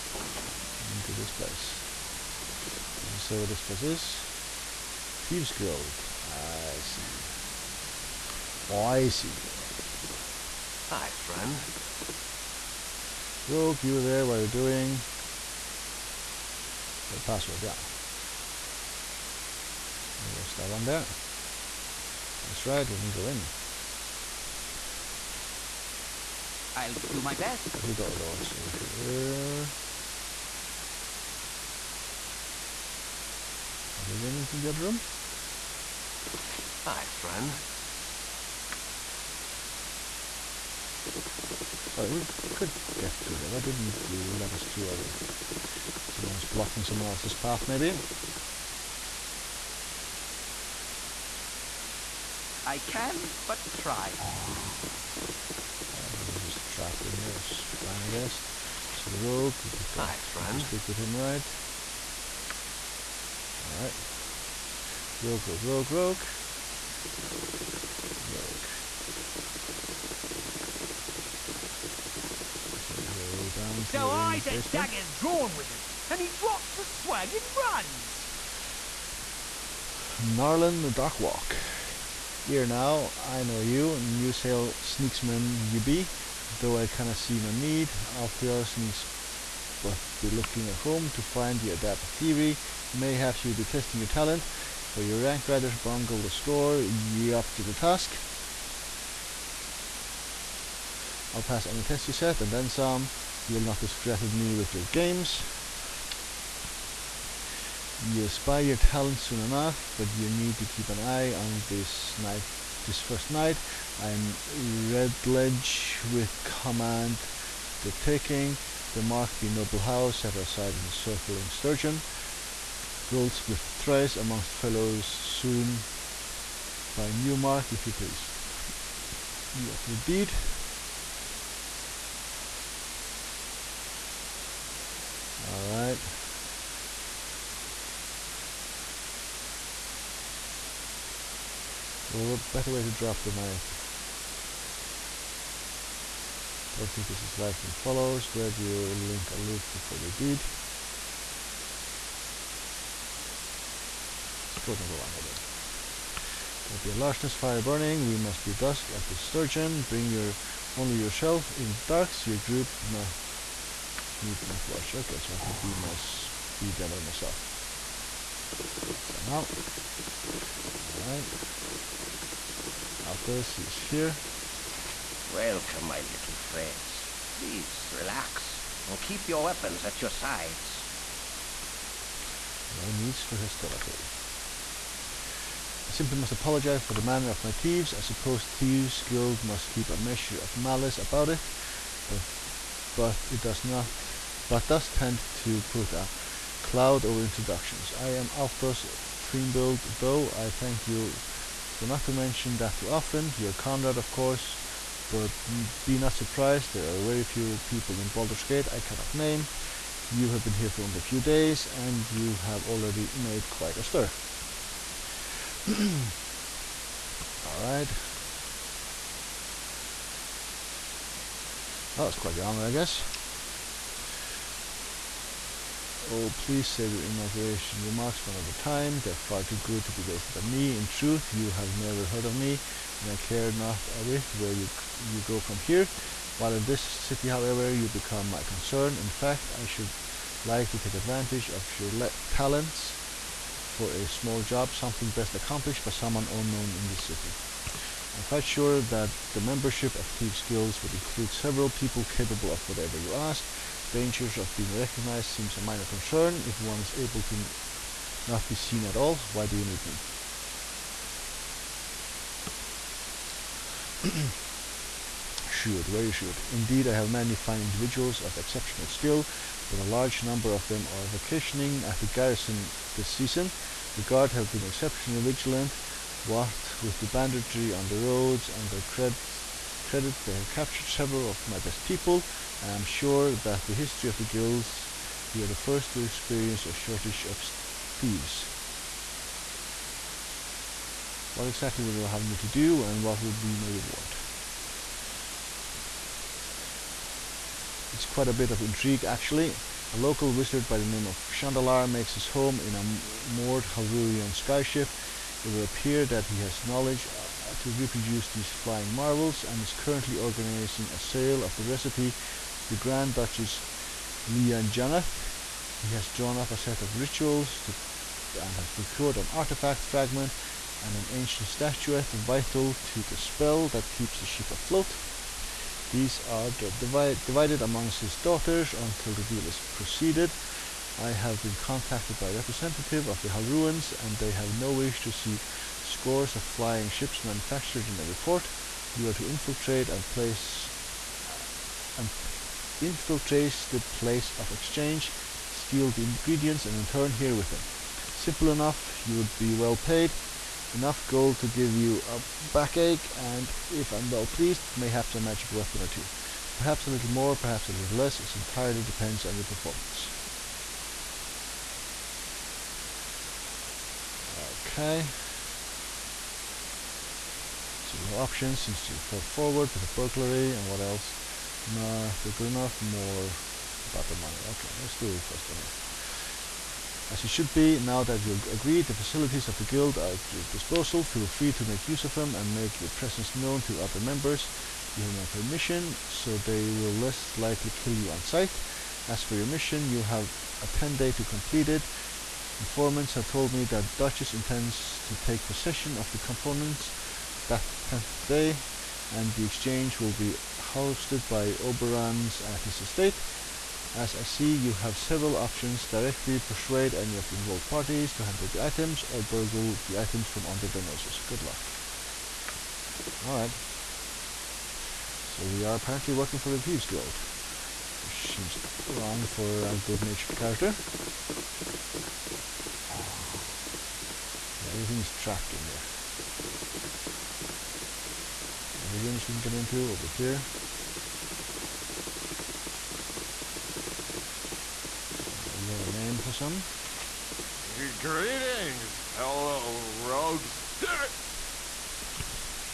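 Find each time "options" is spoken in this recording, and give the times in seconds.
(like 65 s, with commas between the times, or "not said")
368 s, 405 s.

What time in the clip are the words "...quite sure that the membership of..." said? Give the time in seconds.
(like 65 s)
248 s.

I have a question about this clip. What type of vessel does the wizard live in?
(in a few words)
Halruaan skyship.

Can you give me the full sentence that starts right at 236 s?
While in this city, however, you become my concern.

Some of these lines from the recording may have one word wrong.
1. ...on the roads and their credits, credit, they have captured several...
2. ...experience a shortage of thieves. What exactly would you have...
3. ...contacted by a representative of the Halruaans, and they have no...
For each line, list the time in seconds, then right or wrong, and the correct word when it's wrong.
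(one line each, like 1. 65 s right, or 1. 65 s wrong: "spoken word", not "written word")
1. 277 s right
2. 286 s right
3. 331 s right.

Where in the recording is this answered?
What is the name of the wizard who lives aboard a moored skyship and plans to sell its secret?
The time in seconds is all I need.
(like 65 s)
301 s.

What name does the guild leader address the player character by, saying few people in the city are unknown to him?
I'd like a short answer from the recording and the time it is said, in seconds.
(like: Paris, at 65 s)
Conrad, at 203 s.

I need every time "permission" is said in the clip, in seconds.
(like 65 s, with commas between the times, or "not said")
385 s.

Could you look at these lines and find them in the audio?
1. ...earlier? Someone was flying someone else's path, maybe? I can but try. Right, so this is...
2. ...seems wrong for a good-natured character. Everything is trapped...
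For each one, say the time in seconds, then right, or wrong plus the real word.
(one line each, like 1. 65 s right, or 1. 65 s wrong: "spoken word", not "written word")
1. 44 s wrong: "blocking", not "flying"
2. 418 s right.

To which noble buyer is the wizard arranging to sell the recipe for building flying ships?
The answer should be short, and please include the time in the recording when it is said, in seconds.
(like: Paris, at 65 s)
Grand Duchess Liia Jannath, at 312 s.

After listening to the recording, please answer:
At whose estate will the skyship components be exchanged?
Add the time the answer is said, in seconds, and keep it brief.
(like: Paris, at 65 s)
Oberan, at 401 s.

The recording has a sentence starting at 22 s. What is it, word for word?
That's right, we can go in.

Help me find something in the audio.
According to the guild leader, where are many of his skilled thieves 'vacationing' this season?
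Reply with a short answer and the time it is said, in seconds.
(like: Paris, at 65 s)
the garrison, at 271 s.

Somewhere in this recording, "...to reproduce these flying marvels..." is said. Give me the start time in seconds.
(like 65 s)
307 s.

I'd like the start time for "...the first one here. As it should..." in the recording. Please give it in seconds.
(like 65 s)
375 s.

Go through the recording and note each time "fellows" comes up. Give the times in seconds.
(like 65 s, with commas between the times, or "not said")
124 s, 439 s.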